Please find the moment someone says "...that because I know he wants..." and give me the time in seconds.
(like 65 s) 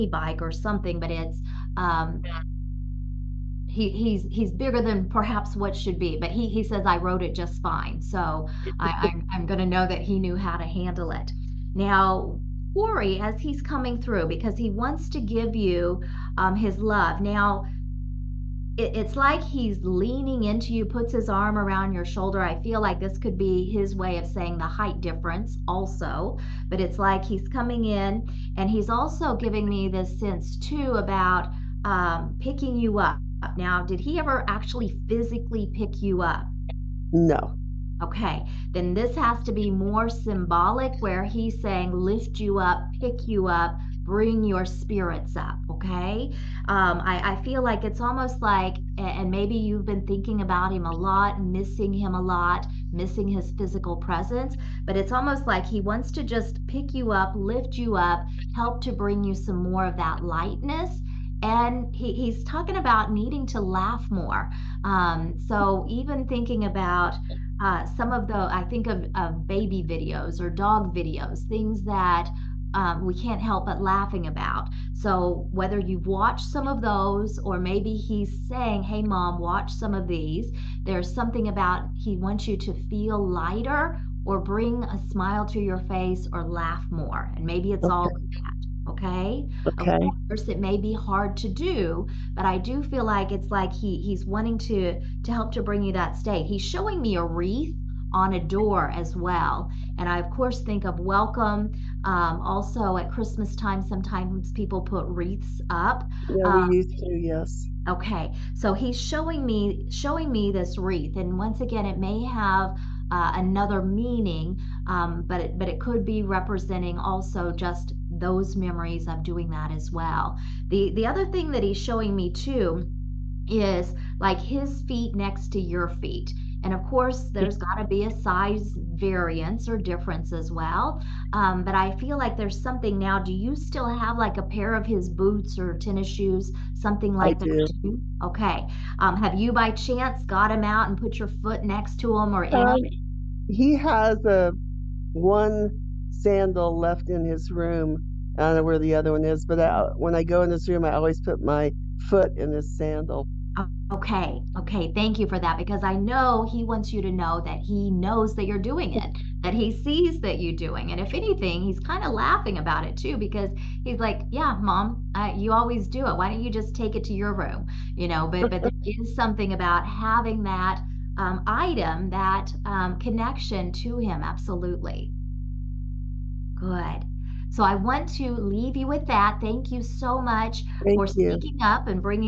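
155 s.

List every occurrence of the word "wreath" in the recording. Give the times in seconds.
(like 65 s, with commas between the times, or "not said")
97 s, 105 s, 110 s.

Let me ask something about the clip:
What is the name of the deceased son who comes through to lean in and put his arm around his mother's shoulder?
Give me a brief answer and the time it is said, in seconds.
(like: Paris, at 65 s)
Corey, at 12 s.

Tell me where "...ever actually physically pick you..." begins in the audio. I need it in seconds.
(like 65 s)
34 s.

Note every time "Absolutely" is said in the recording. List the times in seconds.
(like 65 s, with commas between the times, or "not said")
174 s.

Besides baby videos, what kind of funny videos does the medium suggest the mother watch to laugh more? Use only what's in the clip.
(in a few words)
Dog videos.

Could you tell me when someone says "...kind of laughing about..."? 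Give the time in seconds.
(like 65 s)
161 s.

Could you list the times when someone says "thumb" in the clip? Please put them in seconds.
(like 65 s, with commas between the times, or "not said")
not said.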